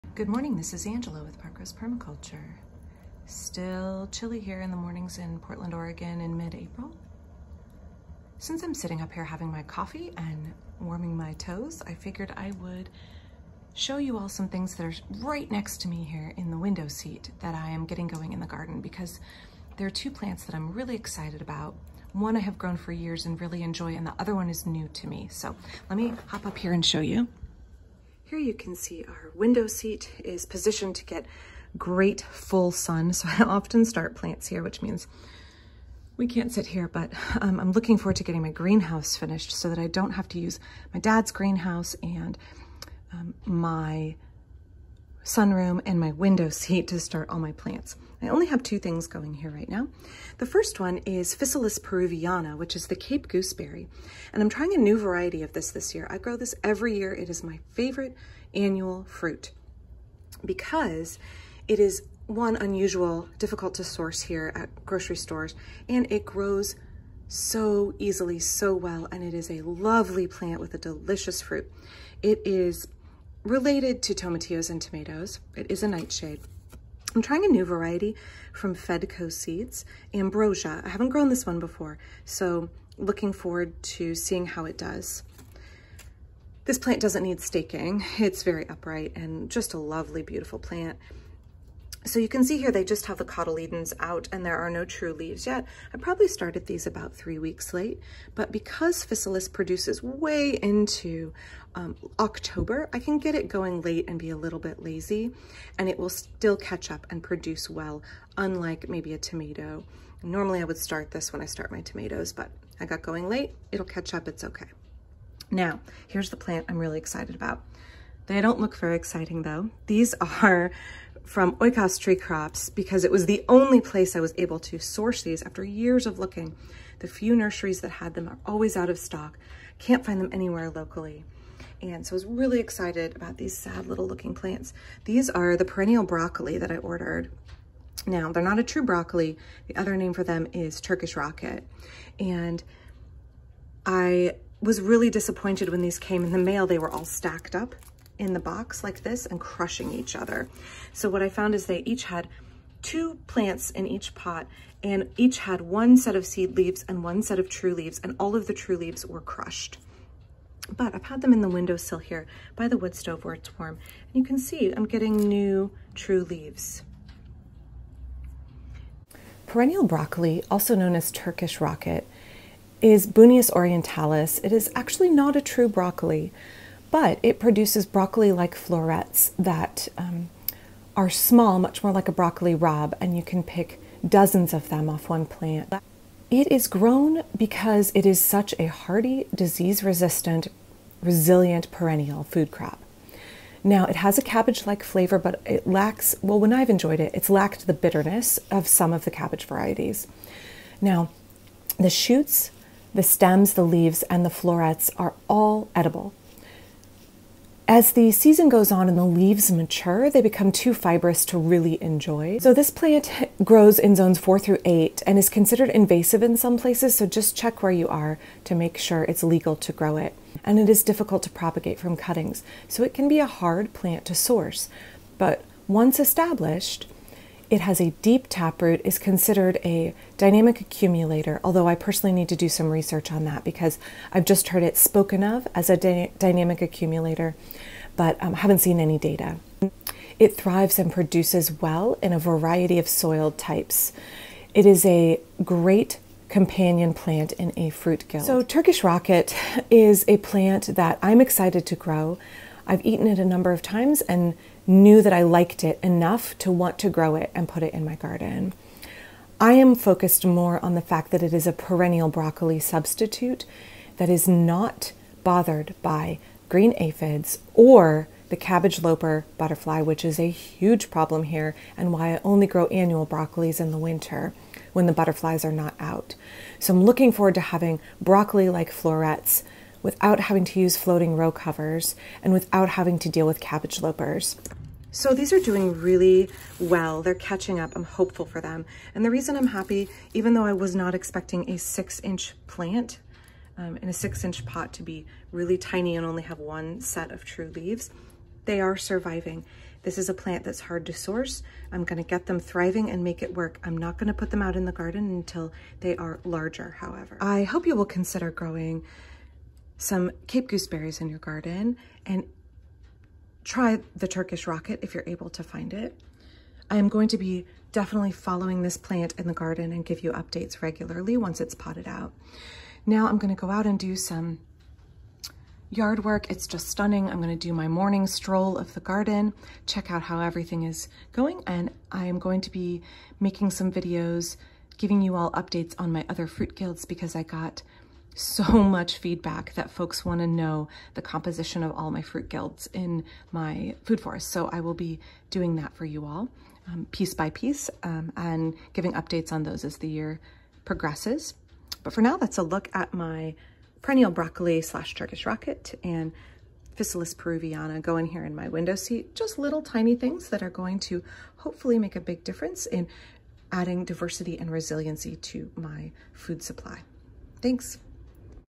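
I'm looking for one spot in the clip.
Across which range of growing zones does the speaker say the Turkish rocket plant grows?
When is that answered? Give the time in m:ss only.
3:33.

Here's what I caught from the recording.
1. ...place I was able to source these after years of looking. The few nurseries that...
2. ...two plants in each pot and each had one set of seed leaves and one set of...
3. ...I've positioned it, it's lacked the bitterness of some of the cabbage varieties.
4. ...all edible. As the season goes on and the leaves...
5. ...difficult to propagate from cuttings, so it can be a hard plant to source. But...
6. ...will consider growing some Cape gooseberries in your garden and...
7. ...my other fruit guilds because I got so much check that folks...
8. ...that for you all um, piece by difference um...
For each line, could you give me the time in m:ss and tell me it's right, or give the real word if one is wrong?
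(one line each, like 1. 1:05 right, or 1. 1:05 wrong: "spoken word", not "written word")
1. 2:03 right
2. 2:32 right
3. 3:16 wrong: "enjoyed", not "positioned"
4. 3:25 right
5. 3:40 right
6. 5:07 right
7. 5:35 wrong: "feedback", not "check"
8. 5:45 wrong: "piece", not "difference".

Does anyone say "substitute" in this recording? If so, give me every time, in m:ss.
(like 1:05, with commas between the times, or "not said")
4:22.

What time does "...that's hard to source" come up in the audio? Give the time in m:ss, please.
5:00.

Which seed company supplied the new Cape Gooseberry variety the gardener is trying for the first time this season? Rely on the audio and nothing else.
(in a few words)
Fedco Seeds.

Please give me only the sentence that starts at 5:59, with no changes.
Just little tiny things that are going to hopefully make a big difference in adding diversity and resiliency to my food supply.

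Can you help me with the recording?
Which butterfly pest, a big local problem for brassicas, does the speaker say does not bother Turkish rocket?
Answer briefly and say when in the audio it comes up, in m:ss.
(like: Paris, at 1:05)
Cabbage looper, at 4:28.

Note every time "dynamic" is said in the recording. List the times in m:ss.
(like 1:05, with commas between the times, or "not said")
3:50, 3:56.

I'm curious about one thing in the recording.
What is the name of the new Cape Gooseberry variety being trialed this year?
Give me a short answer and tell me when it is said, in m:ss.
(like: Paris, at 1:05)
Ambrosia, at 1:20.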